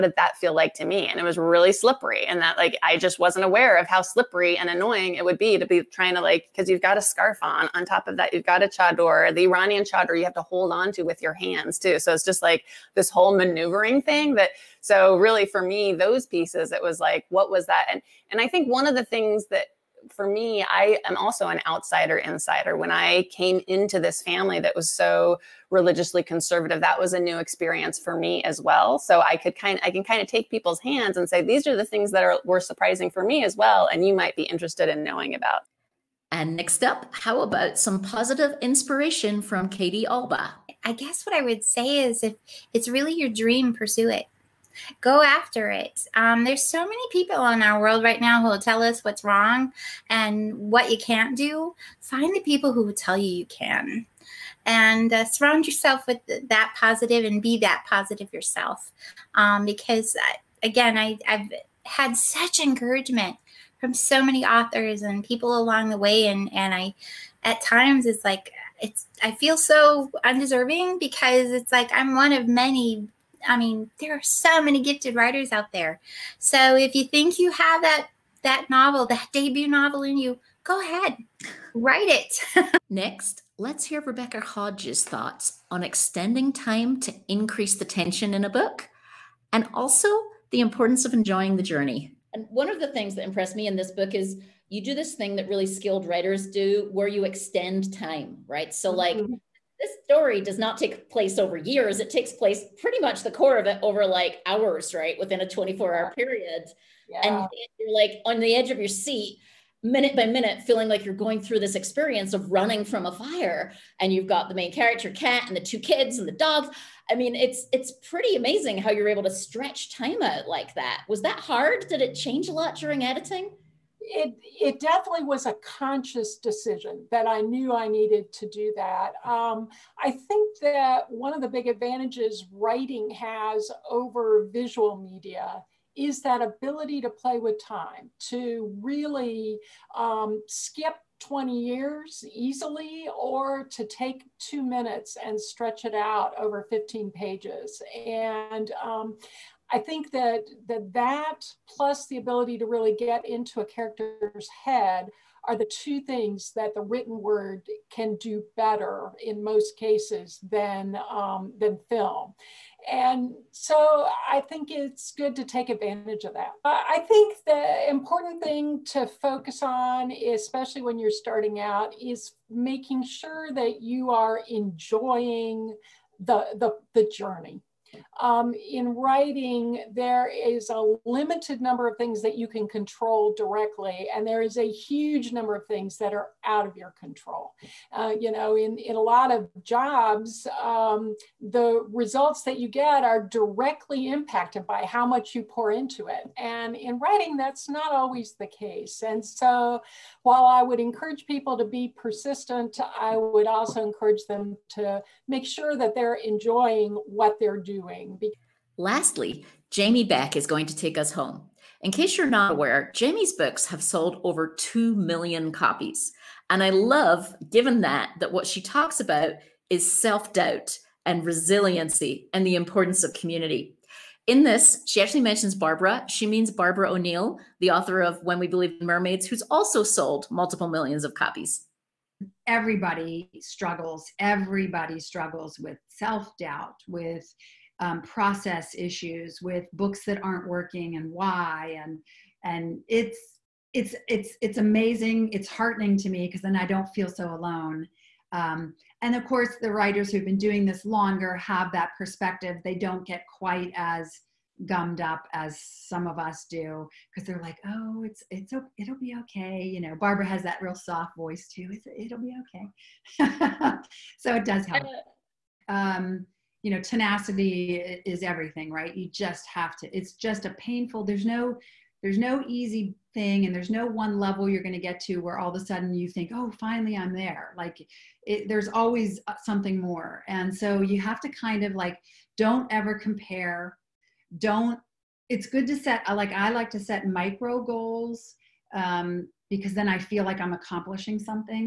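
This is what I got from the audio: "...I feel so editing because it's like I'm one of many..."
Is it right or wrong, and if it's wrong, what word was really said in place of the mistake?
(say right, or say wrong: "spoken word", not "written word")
wrong: "undeserving", not "editing".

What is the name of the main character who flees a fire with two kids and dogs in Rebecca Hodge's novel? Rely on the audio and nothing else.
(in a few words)
Kat.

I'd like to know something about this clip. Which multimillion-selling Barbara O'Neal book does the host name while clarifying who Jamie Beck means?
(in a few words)
When We Believe in Mermaids.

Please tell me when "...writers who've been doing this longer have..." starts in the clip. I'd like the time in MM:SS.
04:09.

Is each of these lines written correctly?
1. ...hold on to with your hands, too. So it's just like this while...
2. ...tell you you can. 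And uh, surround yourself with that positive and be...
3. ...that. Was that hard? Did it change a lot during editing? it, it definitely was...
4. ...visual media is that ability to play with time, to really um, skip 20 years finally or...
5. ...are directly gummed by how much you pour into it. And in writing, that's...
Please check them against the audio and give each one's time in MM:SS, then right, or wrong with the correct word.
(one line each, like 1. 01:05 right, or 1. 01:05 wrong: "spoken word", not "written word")
1. 00:10 wrong: "whole", not "while"
2. 00:52 right
3. 02:00 right
4. 02:14 wrong: "easily", not "finally"
5. 03:13 wrong: "impacted", not "gummed".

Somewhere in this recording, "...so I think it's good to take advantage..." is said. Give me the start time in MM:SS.
02:43.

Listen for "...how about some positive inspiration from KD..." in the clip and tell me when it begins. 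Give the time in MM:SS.
00:37.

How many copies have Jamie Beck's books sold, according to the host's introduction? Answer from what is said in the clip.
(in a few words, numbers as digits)
over 2 million.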